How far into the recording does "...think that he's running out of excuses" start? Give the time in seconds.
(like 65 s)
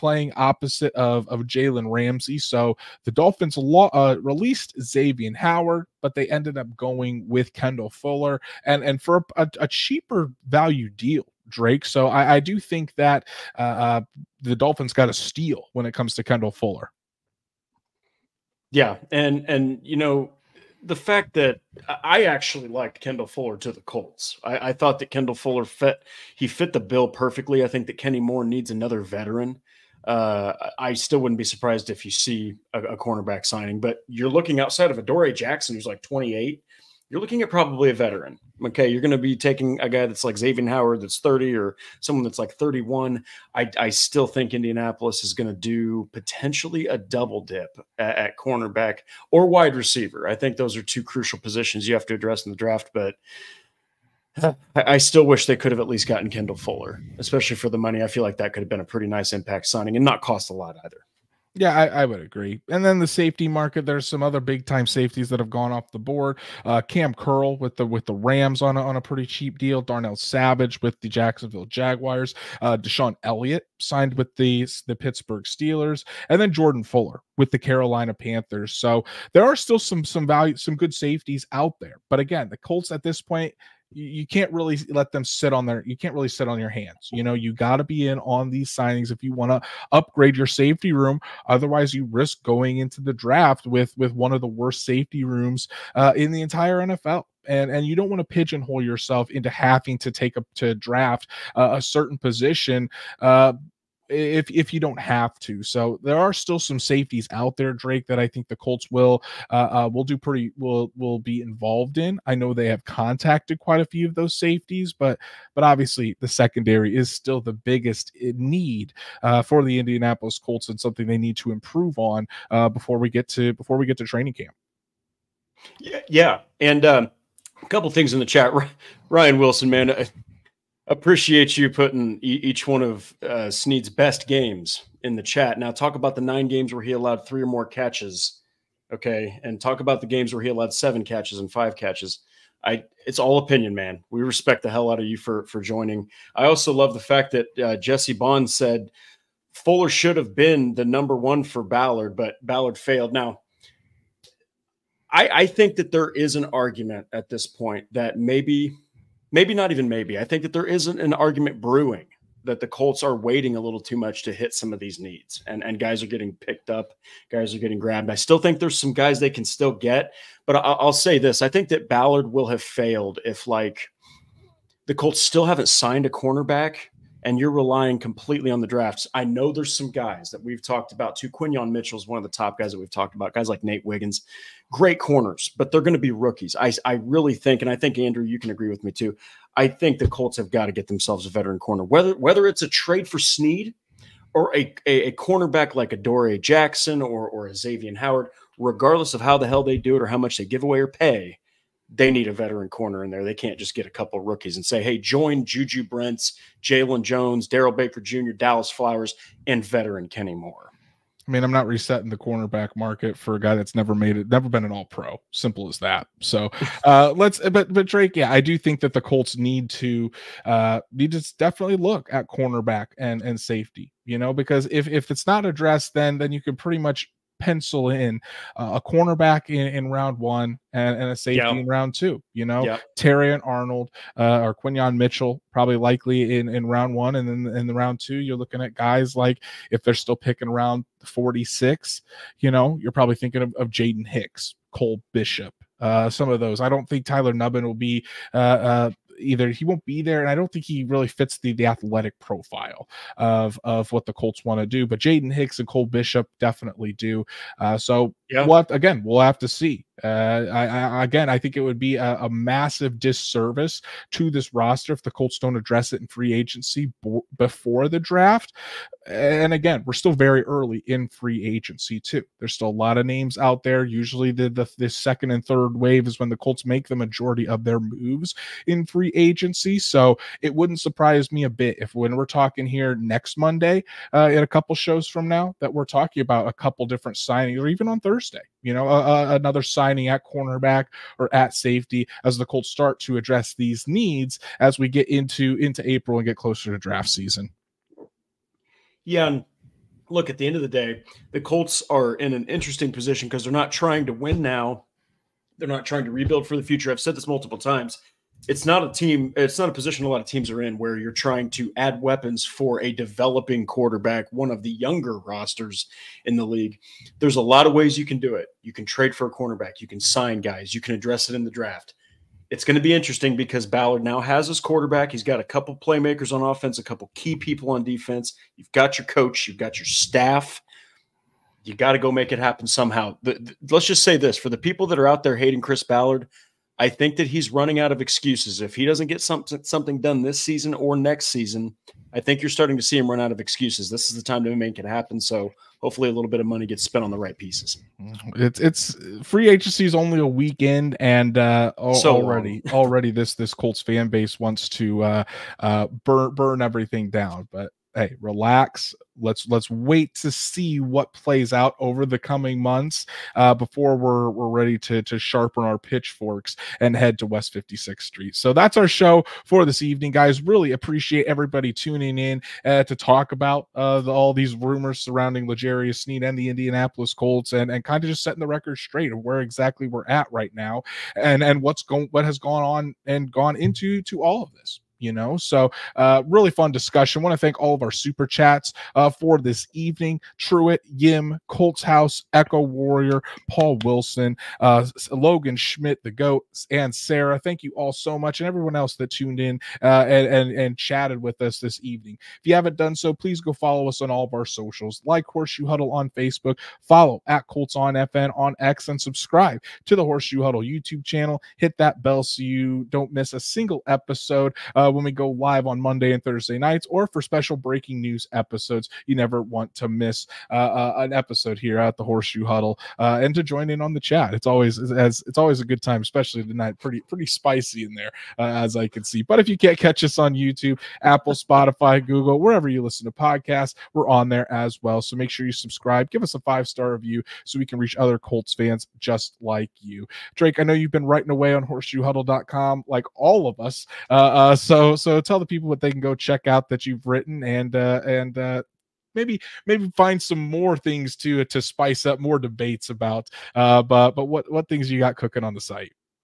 336 s.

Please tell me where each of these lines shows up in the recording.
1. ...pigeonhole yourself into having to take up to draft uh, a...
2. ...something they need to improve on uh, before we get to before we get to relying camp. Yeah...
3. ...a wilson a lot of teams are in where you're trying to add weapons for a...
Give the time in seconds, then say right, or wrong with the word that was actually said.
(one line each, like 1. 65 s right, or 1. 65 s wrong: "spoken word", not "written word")
1. 98 s right
2. 120 s wrong: "training", not "relying"
3. 309 s wrong: "position", not "wilson".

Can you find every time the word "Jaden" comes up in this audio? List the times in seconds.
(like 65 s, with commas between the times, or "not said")
243 s, 254 s.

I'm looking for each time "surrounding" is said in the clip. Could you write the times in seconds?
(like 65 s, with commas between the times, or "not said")
374 s.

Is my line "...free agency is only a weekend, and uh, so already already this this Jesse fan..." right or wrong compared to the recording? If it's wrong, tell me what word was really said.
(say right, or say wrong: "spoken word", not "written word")
wrong: "Colts", not "Jesse".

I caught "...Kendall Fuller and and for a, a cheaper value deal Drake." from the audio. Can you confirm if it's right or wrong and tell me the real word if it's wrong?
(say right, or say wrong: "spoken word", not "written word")
right.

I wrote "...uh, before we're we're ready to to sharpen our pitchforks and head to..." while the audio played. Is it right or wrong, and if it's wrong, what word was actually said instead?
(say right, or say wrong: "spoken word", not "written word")
right.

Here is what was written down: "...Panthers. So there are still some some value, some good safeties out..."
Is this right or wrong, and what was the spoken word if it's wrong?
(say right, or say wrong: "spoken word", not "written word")
right.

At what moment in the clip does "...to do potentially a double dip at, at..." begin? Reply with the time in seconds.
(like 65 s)
45 s.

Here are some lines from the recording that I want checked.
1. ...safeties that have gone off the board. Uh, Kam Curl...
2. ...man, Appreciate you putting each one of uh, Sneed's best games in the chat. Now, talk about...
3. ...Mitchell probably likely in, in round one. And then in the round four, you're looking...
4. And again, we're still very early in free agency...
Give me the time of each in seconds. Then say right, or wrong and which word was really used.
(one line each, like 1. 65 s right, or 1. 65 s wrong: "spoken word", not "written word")
1. 64 s right
2. 129 s right
3. 234 s wrong: "two", not "four"
4. 269 s right.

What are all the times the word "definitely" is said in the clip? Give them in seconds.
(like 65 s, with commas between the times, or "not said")
221 s, 256 s.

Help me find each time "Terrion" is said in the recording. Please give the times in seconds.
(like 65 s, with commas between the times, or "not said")
232 s.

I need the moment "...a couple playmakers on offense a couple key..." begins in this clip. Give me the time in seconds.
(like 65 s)
325 s.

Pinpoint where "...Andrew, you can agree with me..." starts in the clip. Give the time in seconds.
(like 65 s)
187 s.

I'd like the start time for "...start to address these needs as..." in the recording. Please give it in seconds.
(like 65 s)
292 s.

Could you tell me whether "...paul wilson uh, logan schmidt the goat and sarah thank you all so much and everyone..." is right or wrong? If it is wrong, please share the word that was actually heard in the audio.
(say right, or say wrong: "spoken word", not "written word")
right.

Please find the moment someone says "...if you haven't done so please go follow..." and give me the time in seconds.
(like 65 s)
402 s.